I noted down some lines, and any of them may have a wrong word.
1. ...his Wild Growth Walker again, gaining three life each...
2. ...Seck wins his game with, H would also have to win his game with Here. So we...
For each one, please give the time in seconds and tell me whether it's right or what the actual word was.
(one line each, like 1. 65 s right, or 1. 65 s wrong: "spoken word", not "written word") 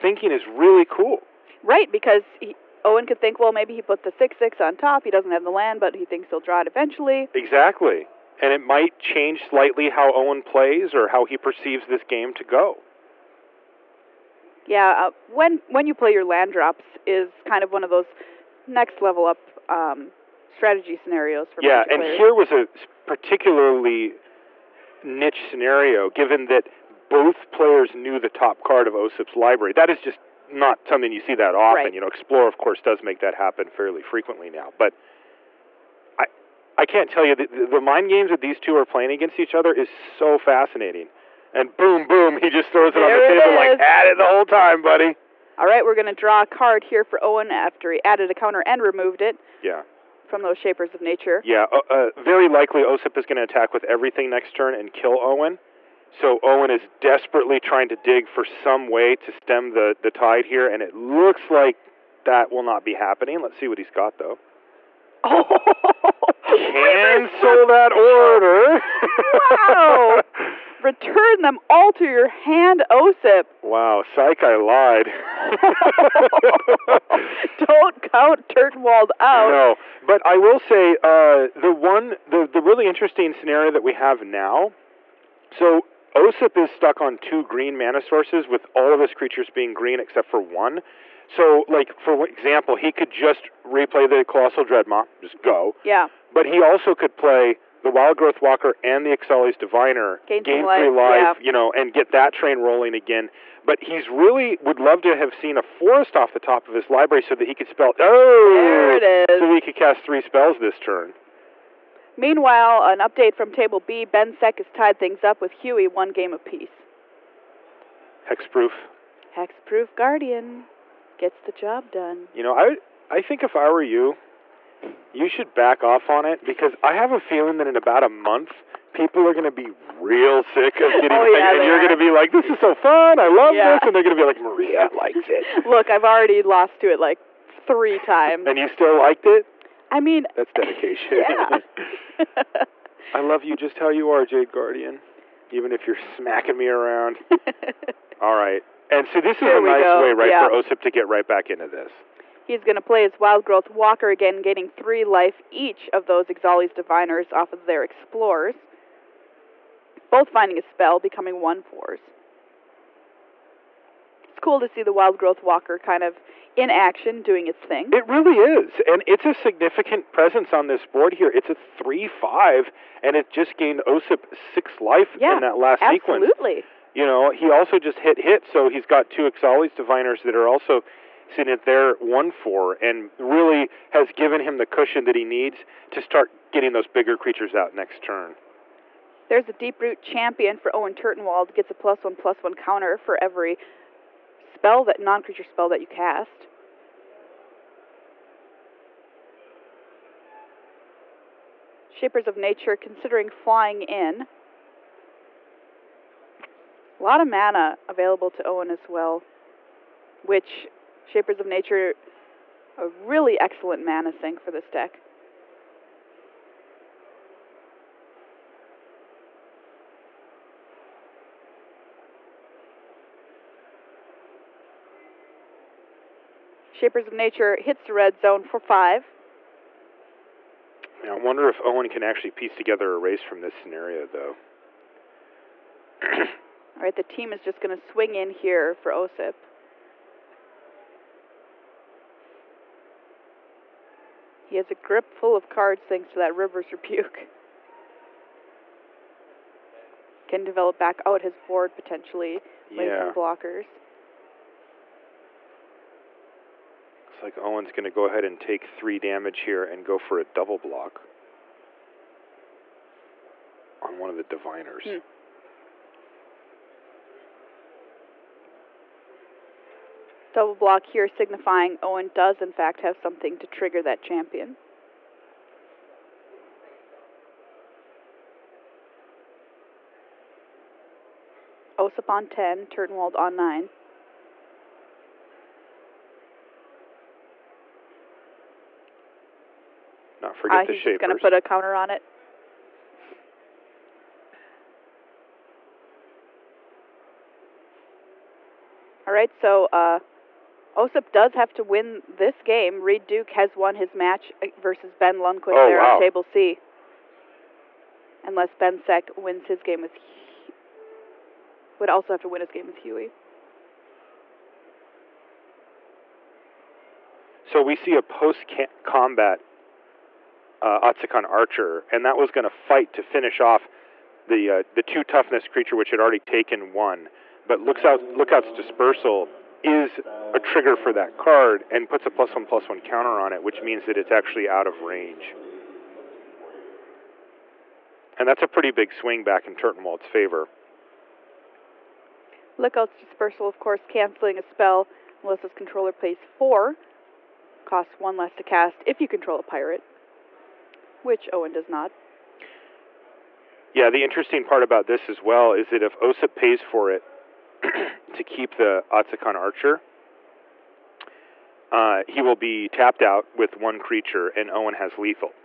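1. 153 s right
2. 308 s wrong: "Huey", not "Here".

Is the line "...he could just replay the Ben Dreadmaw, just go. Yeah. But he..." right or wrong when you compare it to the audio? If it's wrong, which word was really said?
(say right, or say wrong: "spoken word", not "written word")
wrong: "Colossal", not "Ben".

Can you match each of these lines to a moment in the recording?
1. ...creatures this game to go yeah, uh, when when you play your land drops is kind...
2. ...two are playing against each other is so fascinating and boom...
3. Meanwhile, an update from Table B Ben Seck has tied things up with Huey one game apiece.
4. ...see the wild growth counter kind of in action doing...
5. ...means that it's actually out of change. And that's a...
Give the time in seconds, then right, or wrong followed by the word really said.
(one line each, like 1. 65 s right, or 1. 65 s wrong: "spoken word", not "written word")
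1. 11 s wrong: "perceives", not "creatures"
2. 38 s right
3. 112 s right
4. 164 s wrong: "walker", not "counter"
5. 333 s wrong: "range", not "change".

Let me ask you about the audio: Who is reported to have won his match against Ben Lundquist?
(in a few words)
Reed Duke.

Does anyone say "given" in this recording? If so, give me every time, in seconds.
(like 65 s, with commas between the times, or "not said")
26 s, 184 s.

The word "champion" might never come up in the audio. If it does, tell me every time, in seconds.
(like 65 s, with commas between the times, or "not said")
190 s, 274 s.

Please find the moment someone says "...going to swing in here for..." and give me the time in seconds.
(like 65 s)
237 s.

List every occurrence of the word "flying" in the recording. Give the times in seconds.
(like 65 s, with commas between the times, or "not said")
203 s.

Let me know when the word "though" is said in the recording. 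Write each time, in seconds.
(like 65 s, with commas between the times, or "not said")
64 s, 234 s.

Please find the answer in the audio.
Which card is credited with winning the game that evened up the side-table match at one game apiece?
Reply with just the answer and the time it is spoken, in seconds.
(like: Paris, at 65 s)
Hexproof Guardian, at 119 s.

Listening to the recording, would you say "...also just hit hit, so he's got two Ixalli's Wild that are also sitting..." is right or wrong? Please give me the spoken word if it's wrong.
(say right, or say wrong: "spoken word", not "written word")
wrong: "Diviners", not "Wild".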